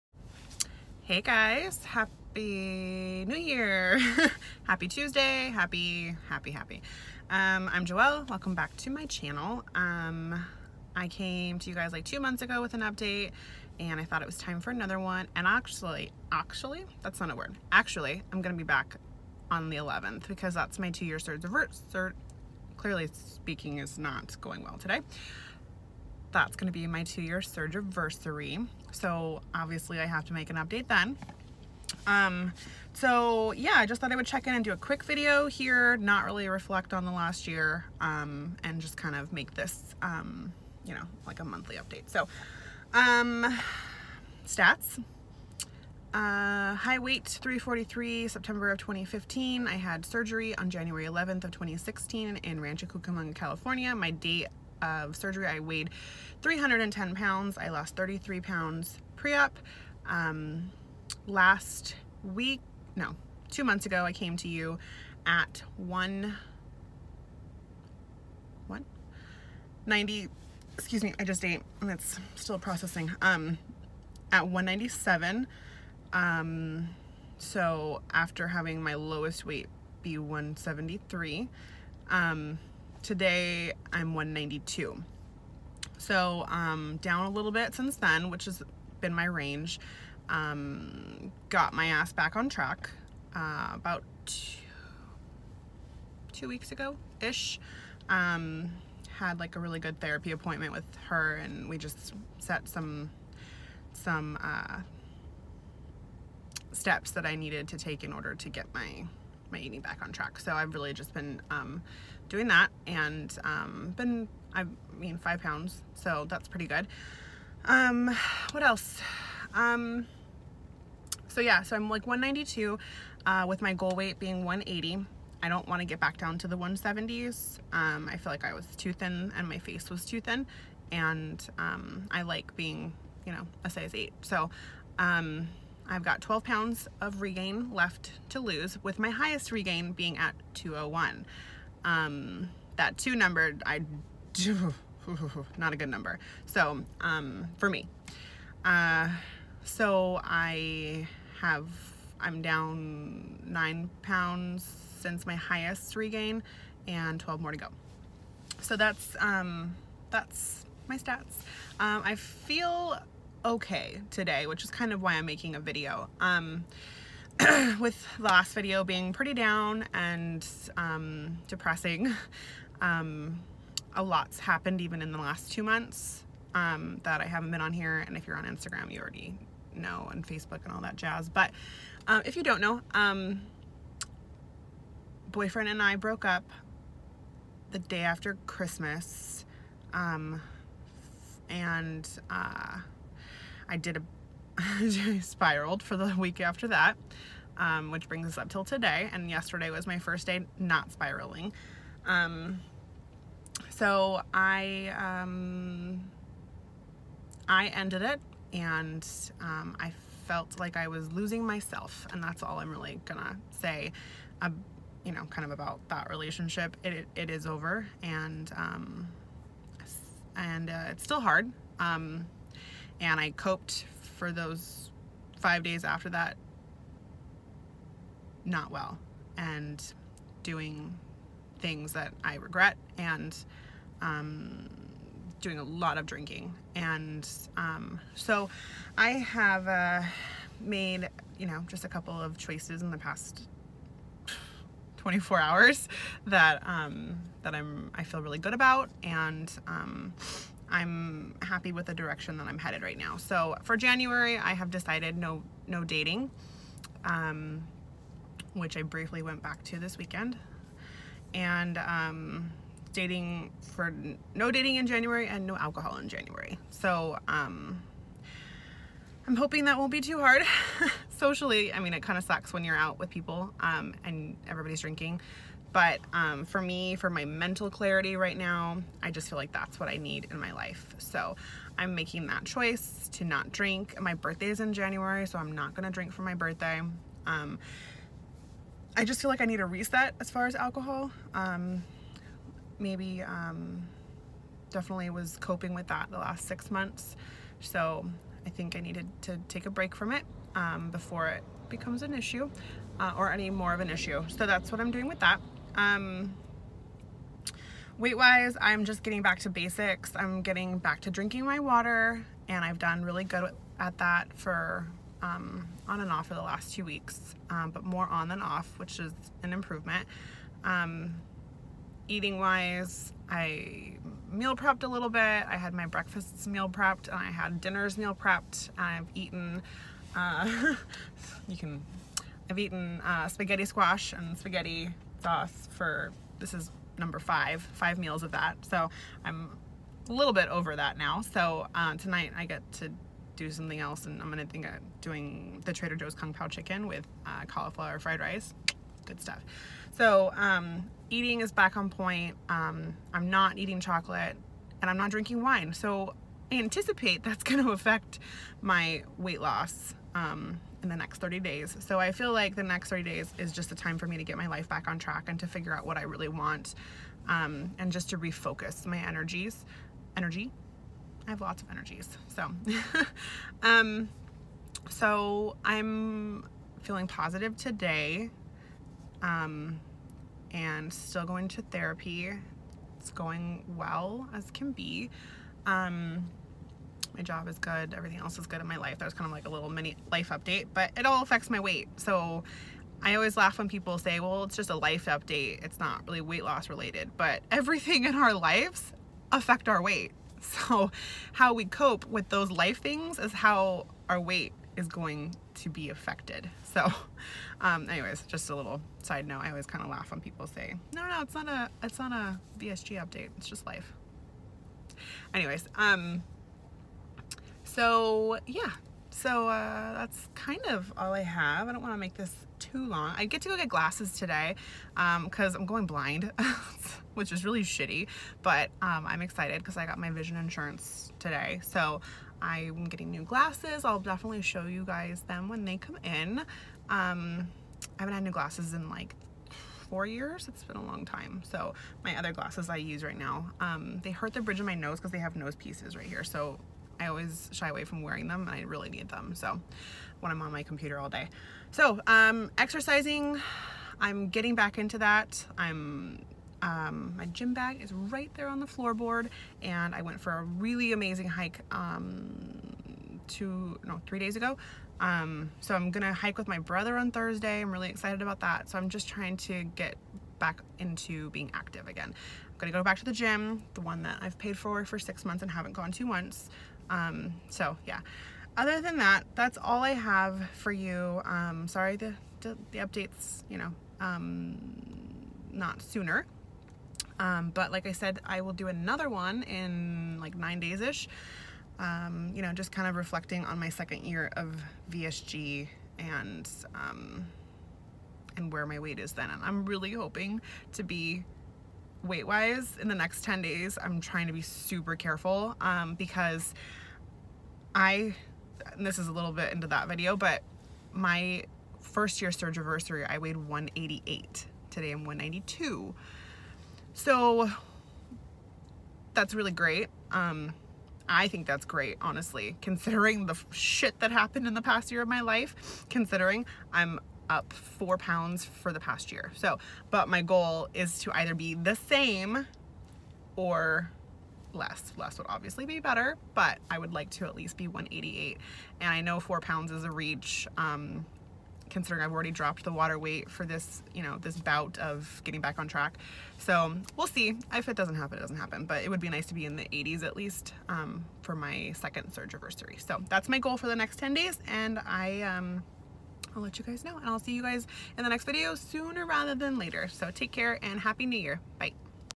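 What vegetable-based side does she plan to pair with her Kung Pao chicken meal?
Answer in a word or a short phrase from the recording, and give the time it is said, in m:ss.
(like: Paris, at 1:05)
cauliflower fried rice, at 5:47.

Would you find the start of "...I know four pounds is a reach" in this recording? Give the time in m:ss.
8:58.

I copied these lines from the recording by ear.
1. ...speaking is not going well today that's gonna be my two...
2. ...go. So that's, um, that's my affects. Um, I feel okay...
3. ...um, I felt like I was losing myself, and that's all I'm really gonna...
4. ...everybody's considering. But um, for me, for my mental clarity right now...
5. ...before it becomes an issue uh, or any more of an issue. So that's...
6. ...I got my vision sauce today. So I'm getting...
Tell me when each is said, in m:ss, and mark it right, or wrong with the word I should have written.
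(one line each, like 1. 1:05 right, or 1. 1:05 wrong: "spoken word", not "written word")
1. 0:23 right
2. 2:37 wrong: "stats", not "affects"
3. 3:29 right
4. 4:34 wrong: "drinking", not "considering"
5. 5:00 right
6. 7:09 wrong: "insurance", not "sauce".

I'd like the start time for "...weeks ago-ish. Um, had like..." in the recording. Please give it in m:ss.
1:36.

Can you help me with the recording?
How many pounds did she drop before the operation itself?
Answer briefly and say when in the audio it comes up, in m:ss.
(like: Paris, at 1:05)
33, at 0:57.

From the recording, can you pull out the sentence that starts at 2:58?
And if you're on Instagram, you already know, and Facebook and all that jazz.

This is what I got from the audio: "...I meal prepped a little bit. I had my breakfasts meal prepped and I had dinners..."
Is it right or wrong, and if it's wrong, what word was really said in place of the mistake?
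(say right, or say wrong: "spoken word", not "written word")
right.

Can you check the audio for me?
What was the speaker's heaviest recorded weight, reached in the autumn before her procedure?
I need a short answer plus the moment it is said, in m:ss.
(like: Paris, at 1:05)
343, at 0:47.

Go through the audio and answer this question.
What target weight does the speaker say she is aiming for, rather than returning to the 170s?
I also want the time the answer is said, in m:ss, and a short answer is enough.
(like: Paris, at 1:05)
180, at 2:04.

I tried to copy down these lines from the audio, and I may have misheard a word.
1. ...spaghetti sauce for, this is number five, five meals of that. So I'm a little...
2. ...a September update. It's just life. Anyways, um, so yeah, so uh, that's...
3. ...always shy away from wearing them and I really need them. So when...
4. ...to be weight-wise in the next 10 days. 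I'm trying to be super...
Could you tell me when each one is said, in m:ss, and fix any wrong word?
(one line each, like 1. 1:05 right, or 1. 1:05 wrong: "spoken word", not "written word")
1. 5:34 right
2. 6:52 wrong: "VSG", not "September"
3. 7:27 right
4. 8:20 right.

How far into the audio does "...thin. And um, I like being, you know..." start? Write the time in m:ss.
2:10.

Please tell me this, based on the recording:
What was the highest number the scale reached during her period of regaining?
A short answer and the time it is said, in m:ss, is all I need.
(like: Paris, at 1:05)
201, at 2:20.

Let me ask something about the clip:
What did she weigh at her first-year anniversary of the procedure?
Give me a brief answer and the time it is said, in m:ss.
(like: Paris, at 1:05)
188, at 8:33.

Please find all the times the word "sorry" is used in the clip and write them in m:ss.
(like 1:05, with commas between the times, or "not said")
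8:01.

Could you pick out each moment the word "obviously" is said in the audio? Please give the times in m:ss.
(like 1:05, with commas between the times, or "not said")
0:29, 8:55.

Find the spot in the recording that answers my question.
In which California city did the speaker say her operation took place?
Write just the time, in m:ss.
0:52.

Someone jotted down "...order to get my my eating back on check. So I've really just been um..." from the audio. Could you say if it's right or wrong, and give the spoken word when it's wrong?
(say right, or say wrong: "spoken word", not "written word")
wrong: "track", not "check".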